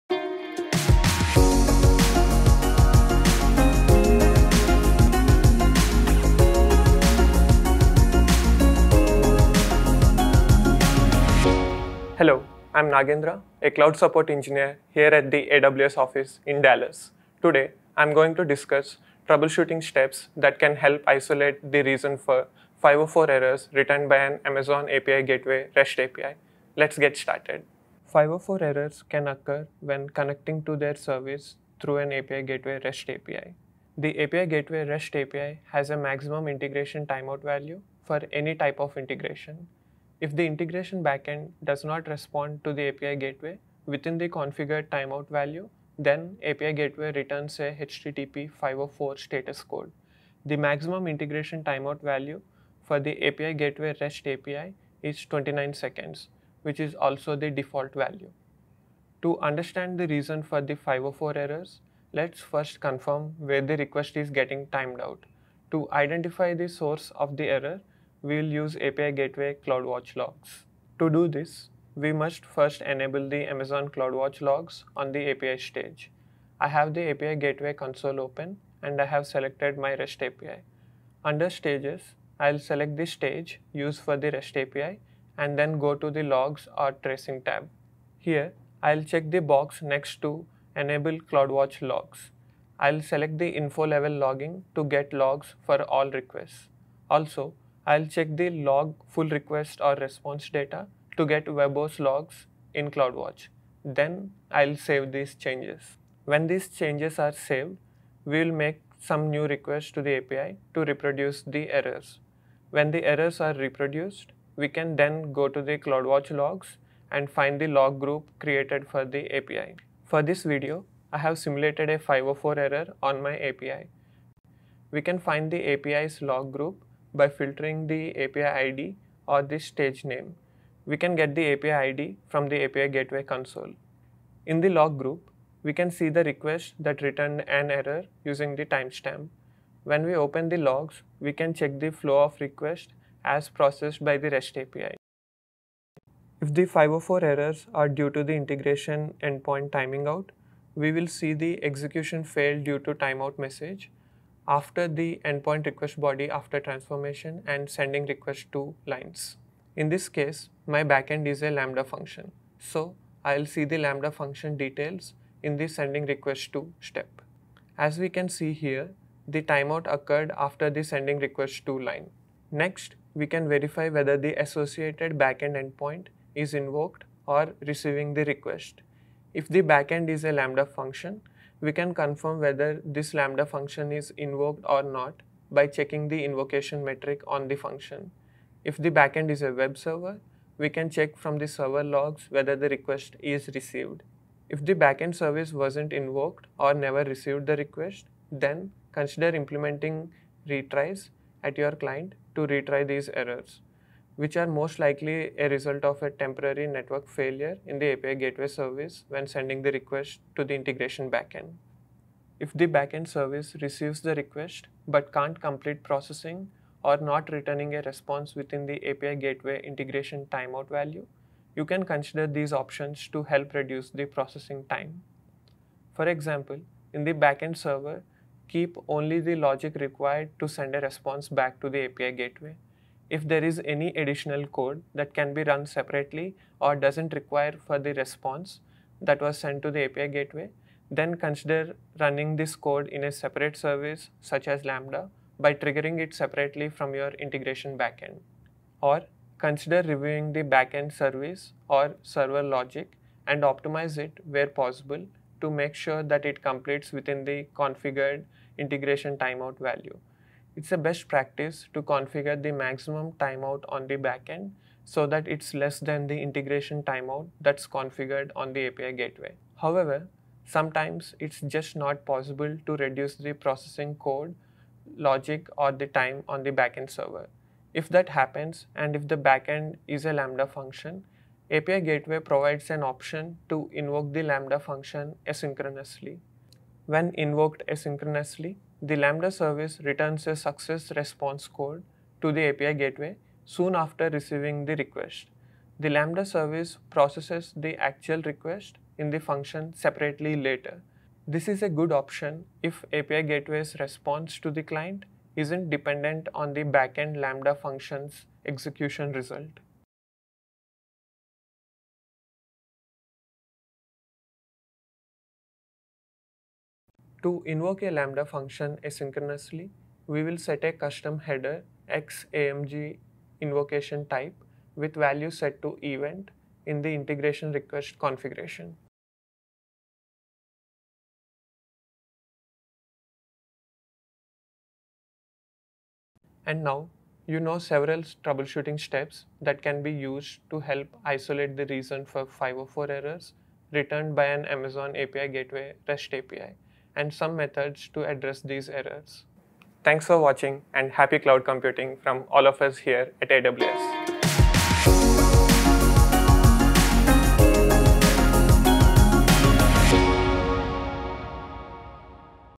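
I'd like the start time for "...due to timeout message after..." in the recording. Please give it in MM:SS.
02:32.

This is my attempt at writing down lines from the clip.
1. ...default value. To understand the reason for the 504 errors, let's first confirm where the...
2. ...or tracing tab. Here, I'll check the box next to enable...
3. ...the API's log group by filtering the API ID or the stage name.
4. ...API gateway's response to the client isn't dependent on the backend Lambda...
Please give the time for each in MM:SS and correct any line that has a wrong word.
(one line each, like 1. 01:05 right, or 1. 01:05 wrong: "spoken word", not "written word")
1. 00:57 right
2. 01:26 right
3. 02:05 right
4. 05:02 right.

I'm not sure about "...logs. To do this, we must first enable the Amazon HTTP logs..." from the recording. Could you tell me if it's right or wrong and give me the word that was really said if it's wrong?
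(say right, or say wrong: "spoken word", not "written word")
wrong: "CloudWatch", not "HTTP".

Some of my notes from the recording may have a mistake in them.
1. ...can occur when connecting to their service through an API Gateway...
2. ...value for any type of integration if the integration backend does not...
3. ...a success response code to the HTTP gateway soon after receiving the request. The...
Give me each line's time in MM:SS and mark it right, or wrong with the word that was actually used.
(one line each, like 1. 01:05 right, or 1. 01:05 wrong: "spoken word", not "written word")
1. 00:29 right
2. 00:37 right
3. 04:50 wrong: "API", not "HTTP".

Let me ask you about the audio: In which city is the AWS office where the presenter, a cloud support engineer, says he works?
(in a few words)
Dallas.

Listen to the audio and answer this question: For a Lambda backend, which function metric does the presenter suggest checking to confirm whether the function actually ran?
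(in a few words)
invocation metric.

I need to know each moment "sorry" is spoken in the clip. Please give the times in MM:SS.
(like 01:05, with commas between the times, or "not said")
not said.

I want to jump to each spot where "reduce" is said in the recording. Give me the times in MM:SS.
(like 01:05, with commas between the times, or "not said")
03:43, 04:32.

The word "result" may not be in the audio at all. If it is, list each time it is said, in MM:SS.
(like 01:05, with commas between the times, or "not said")
03:25, 05:09.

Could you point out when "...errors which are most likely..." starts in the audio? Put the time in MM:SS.
03:23.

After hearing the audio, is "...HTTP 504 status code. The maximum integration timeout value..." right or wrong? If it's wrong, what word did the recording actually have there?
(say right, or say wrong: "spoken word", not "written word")
right.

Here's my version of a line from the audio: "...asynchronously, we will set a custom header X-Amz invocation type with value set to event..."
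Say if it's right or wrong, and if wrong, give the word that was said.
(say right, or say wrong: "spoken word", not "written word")
right.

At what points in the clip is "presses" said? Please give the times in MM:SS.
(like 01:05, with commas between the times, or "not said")
not said.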